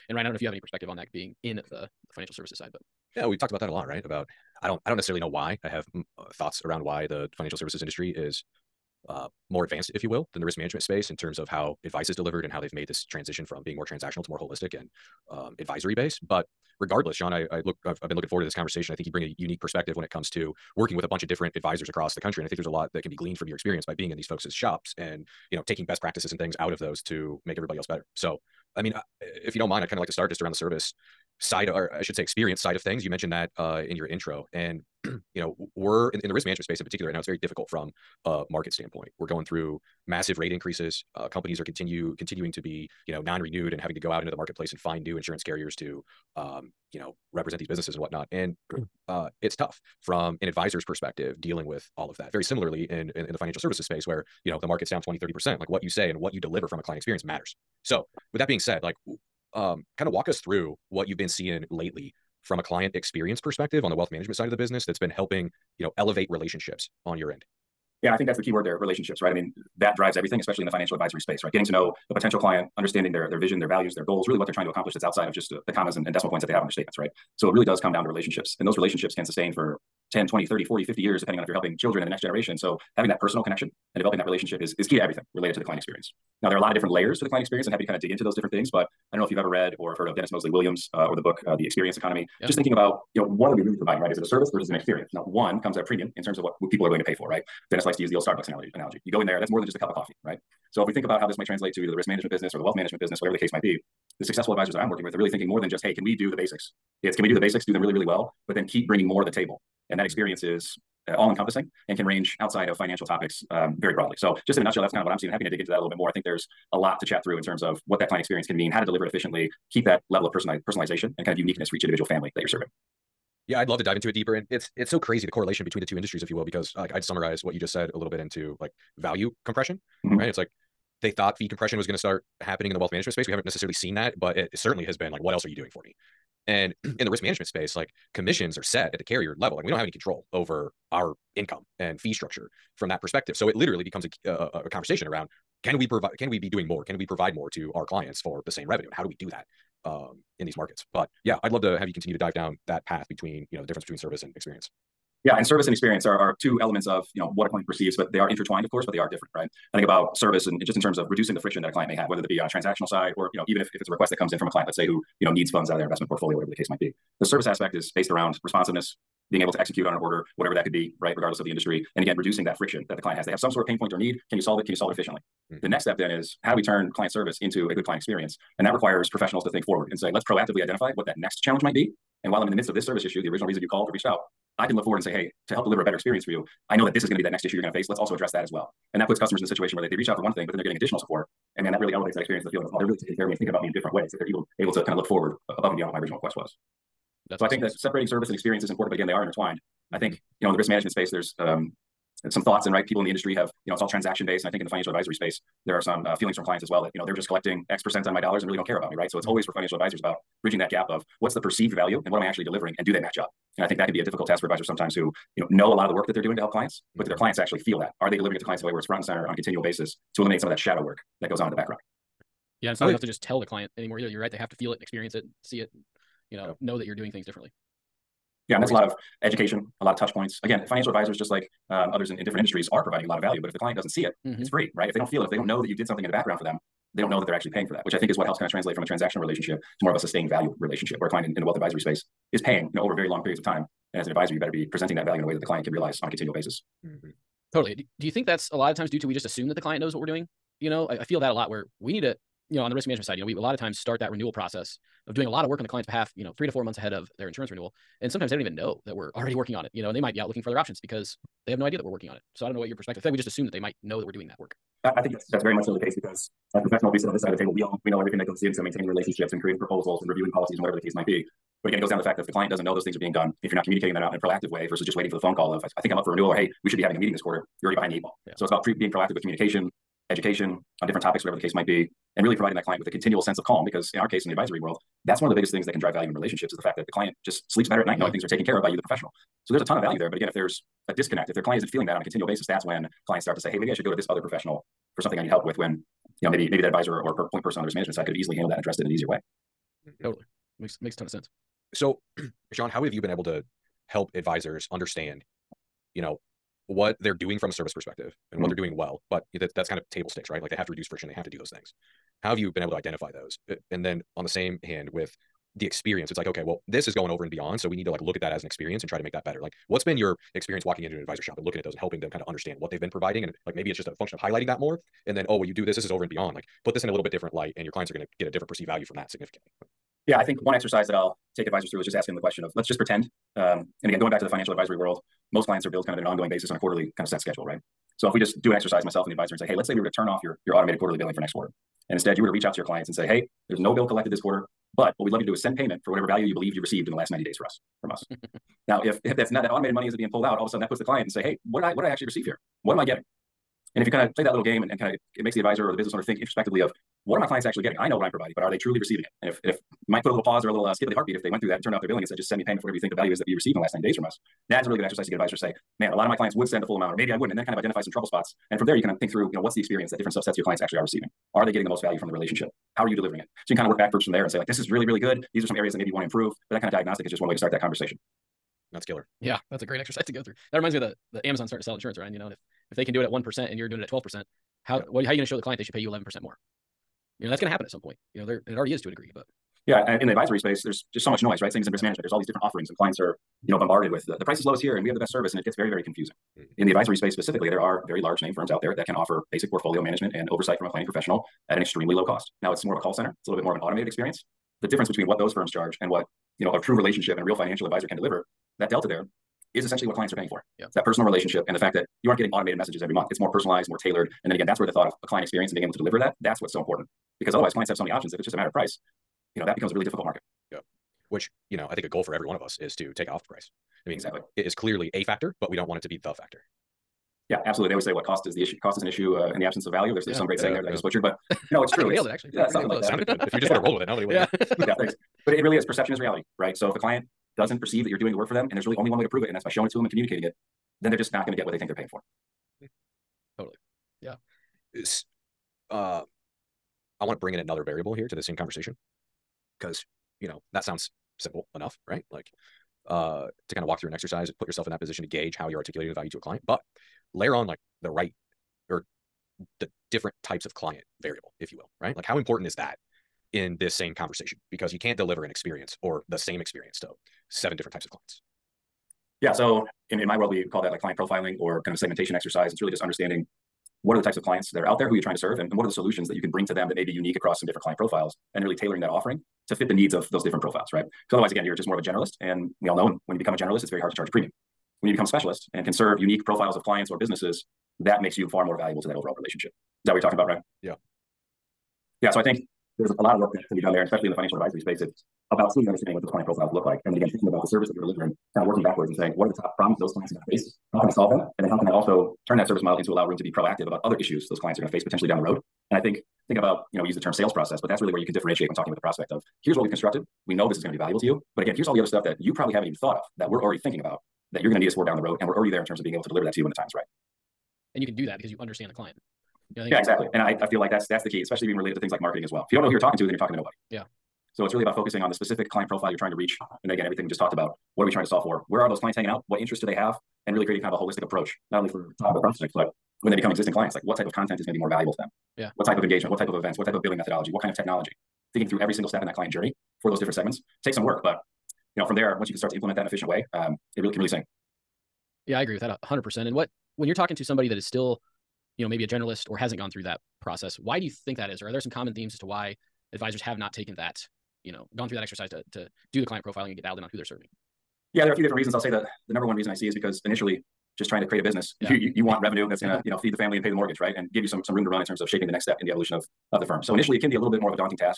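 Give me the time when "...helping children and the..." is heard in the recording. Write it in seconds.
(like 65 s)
81 s.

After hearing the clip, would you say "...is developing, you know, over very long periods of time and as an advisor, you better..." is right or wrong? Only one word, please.
wrong.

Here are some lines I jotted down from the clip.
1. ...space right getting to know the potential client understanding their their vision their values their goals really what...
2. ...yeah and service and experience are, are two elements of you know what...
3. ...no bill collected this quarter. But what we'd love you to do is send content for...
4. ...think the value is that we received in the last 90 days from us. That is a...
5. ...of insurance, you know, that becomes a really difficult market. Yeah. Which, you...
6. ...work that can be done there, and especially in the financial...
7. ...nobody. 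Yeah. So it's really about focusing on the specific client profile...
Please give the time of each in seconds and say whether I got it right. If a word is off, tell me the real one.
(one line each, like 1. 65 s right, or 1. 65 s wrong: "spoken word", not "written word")
1. 71 s right
2. 155 s right
3. 343 s wrong: "payment", not "content"
4. 362 s right
5. 418 s wrong: "price", not "insurance"
6. 493 s right
7. 523 s right.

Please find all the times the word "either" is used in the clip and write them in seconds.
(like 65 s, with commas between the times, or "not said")
101 s, 223 s.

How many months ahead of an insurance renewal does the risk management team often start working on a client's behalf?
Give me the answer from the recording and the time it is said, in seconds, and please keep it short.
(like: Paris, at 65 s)
3 to 4 months, at 256 s.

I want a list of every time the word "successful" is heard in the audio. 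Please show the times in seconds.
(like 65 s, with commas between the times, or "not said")
104 s.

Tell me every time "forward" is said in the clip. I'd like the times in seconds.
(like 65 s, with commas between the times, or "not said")
18 s, 179 s, 184 s, 195 s.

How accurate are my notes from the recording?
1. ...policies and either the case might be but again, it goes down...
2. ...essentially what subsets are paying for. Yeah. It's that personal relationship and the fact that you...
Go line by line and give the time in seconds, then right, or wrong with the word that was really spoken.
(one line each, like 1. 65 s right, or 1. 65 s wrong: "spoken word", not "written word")
1. 270 s wrong: "whatever", not "either"
2. 409 s wrong: "clients", not "subsets".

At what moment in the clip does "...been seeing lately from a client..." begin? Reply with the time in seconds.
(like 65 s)
61 s.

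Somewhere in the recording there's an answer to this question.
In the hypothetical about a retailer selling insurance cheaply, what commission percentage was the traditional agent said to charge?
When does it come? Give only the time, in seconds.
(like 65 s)
383 s.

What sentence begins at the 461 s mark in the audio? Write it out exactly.
Like, how important is that in this same conversation?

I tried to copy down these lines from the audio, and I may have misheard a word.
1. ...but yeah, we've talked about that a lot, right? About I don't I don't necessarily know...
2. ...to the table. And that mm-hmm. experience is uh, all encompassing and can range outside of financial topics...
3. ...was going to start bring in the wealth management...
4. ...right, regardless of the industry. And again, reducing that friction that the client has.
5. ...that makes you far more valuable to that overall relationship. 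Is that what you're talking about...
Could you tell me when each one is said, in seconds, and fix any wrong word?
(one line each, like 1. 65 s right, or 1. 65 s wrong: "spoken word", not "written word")
1. 2 s right
2. 109 s right
3. 131 s wrong: "happening", not "bring"
4. 171 s right
5. 487 s right.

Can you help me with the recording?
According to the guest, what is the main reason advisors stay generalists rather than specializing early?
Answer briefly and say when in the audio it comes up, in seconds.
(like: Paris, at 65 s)
Trying to create a business, at 561 s.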